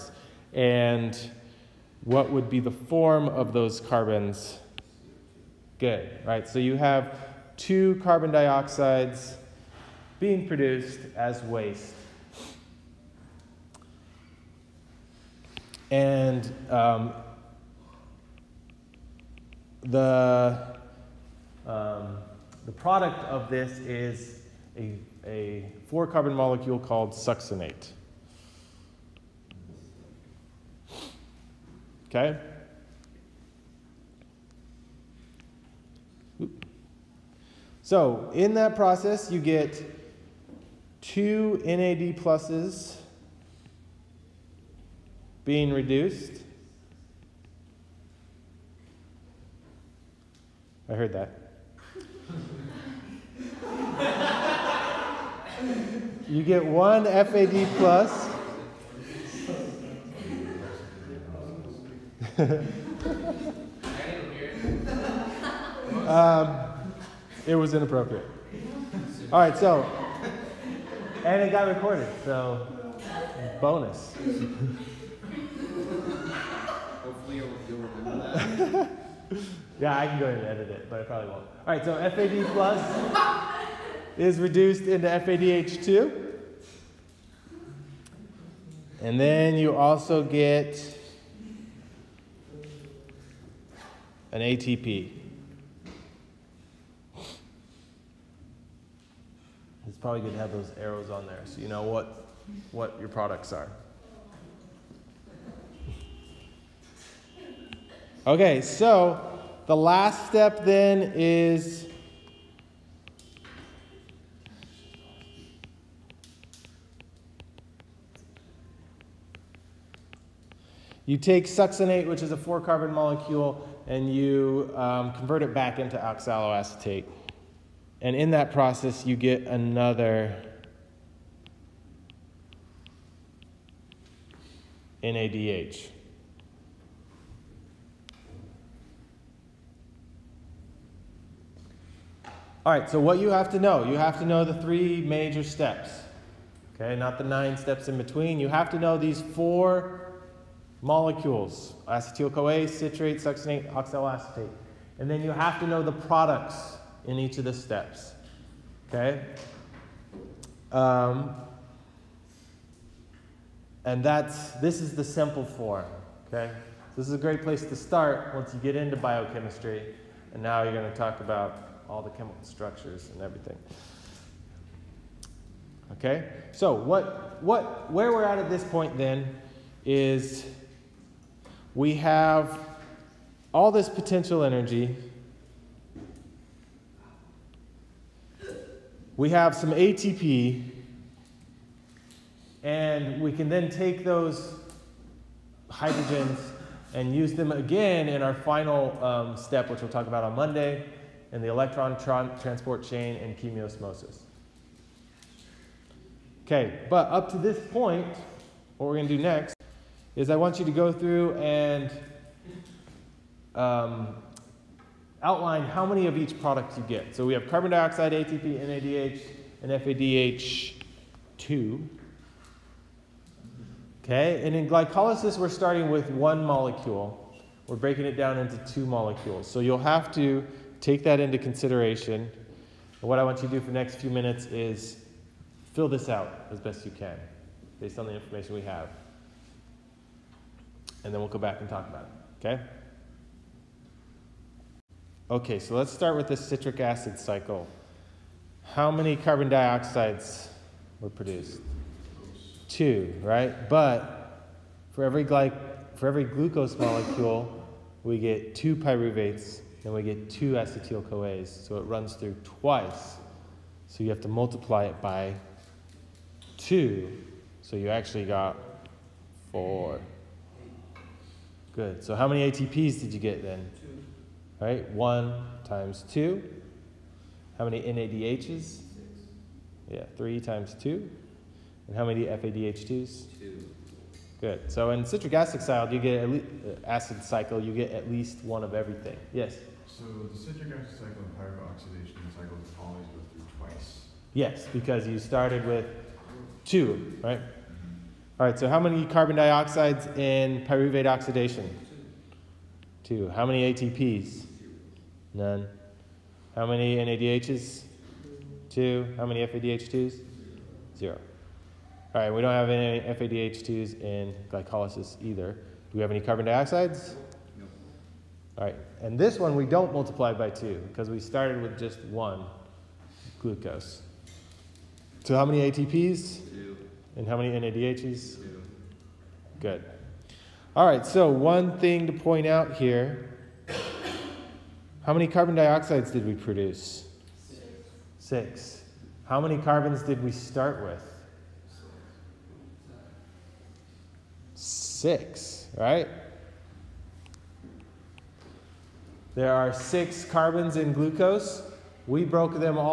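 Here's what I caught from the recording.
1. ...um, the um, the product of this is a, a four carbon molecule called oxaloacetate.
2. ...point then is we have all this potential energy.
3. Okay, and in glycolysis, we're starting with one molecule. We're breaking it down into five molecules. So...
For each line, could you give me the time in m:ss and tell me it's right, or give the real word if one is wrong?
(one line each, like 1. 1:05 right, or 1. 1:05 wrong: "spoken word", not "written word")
1. 0:16 wrong: "succinate", not "oxaloacetate"
2. 2:58 right
3. 3:44 wrong: "two", not "five".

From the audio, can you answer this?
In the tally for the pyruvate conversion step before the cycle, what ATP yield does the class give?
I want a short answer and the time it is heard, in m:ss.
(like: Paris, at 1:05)
None, at 5:05.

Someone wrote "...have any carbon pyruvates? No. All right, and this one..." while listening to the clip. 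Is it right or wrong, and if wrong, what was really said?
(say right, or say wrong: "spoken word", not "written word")
wrong: "dioxides", not "pyruvates".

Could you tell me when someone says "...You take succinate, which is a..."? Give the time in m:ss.
2:01.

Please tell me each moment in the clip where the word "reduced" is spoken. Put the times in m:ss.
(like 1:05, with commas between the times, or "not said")
0:45, 1:24.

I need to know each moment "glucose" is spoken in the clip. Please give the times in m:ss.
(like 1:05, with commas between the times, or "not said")
4:16, 5:23, 5:50.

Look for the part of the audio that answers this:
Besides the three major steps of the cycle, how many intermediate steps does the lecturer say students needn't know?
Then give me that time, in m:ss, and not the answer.
2:27.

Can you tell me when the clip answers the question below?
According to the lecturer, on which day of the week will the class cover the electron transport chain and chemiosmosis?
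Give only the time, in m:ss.
3:20.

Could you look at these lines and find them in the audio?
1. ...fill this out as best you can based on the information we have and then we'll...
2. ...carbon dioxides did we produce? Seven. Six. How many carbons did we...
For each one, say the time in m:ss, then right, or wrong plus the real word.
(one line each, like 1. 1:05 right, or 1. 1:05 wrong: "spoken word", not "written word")
1. 3:55 right
2. 5:35 wrong: "Six", not "Seven".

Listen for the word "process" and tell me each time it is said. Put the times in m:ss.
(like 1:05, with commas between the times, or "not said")
0:38, 2:08.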